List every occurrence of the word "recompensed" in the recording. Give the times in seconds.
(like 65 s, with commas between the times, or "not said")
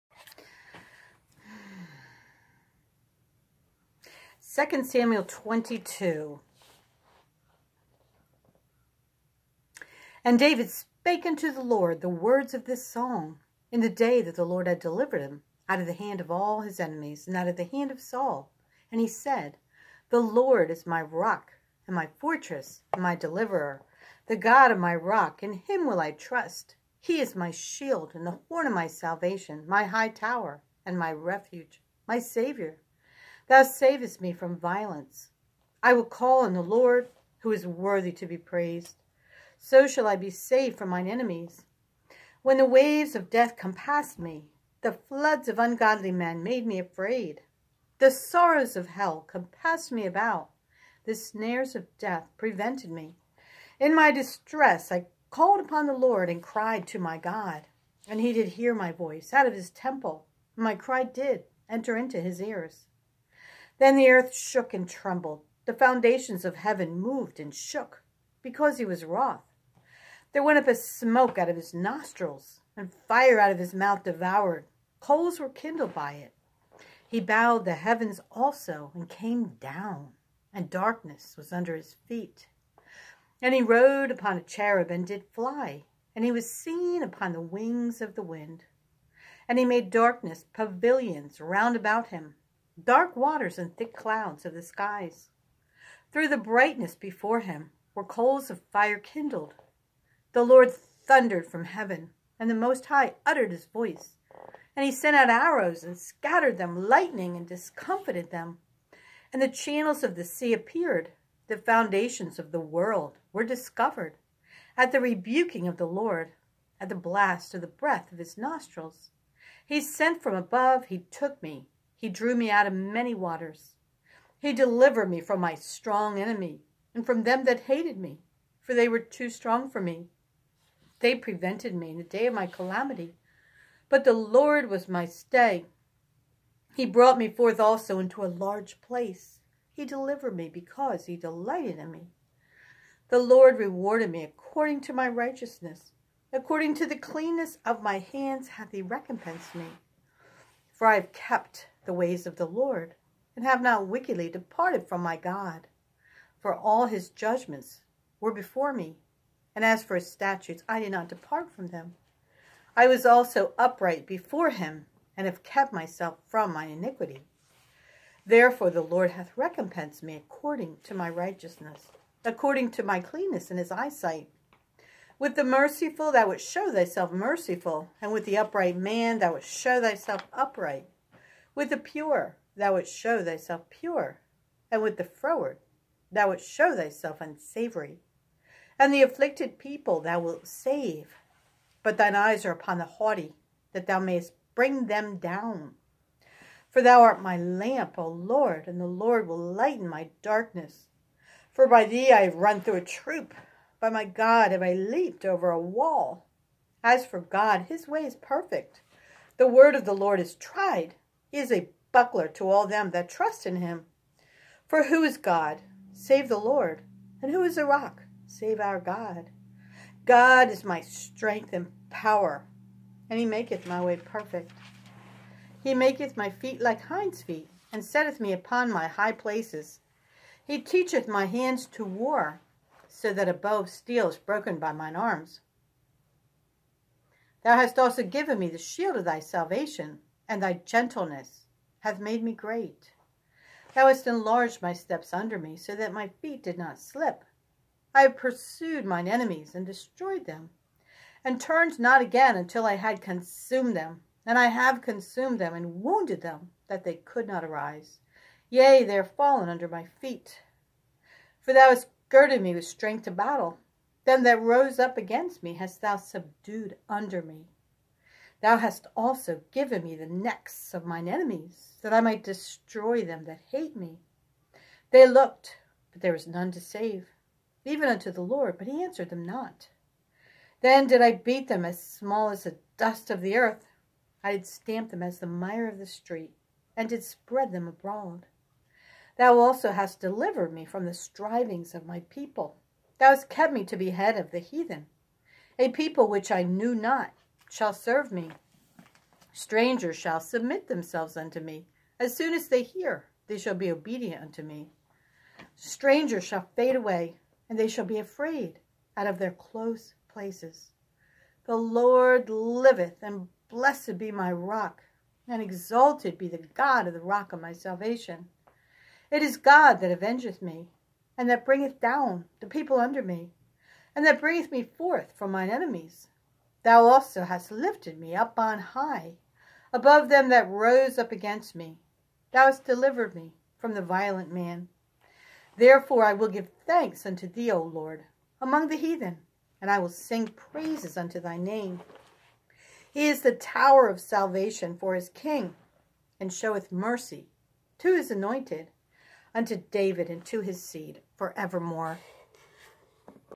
148 s, 169 s.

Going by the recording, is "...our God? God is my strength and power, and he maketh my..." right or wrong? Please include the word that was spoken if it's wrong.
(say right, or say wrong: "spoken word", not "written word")
right.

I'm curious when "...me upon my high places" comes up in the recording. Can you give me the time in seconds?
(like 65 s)
228 s.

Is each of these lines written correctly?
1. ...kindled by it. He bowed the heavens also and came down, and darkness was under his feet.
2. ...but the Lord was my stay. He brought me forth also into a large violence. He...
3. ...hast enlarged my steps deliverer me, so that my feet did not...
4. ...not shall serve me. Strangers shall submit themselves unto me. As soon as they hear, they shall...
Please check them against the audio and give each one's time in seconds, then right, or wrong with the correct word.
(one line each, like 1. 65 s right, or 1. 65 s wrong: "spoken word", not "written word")
1. 75 s right
2. 133 s wrong: "place", not "violence"
3. 243 s wrong: "under", not "deliverer"
4. 296 s right.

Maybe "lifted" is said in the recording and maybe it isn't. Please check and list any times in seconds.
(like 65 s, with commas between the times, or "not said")
327 s.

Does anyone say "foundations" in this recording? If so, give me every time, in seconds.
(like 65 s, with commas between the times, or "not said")
65 s, 111 s.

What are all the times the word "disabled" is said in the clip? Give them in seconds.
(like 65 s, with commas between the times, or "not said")
not said.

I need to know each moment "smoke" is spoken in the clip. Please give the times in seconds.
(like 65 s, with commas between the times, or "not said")
70 s.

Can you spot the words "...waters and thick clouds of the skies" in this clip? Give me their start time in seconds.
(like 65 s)
93 s.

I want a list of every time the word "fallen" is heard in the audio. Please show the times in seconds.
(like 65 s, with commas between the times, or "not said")
259 s.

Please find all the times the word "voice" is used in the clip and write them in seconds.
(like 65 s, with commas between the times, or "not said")
58 s, 103 s.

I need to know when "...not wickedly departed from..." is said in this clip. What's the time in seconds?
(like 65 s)
153 s.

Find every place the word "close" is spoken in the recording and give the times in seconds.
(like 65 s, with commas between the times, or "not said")
309 s.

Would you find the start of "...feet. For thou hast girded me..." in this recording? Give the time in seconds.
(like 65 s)
259 s.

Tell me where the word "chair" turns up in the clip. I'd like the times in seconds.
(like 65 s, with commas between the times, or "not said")
not said.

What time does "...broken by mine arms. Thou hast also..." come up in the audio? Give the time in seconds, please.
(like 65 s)
234 s.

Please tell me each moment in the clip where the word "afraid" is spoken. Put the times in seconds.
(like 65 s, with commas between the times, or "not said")
46 s, 307 s.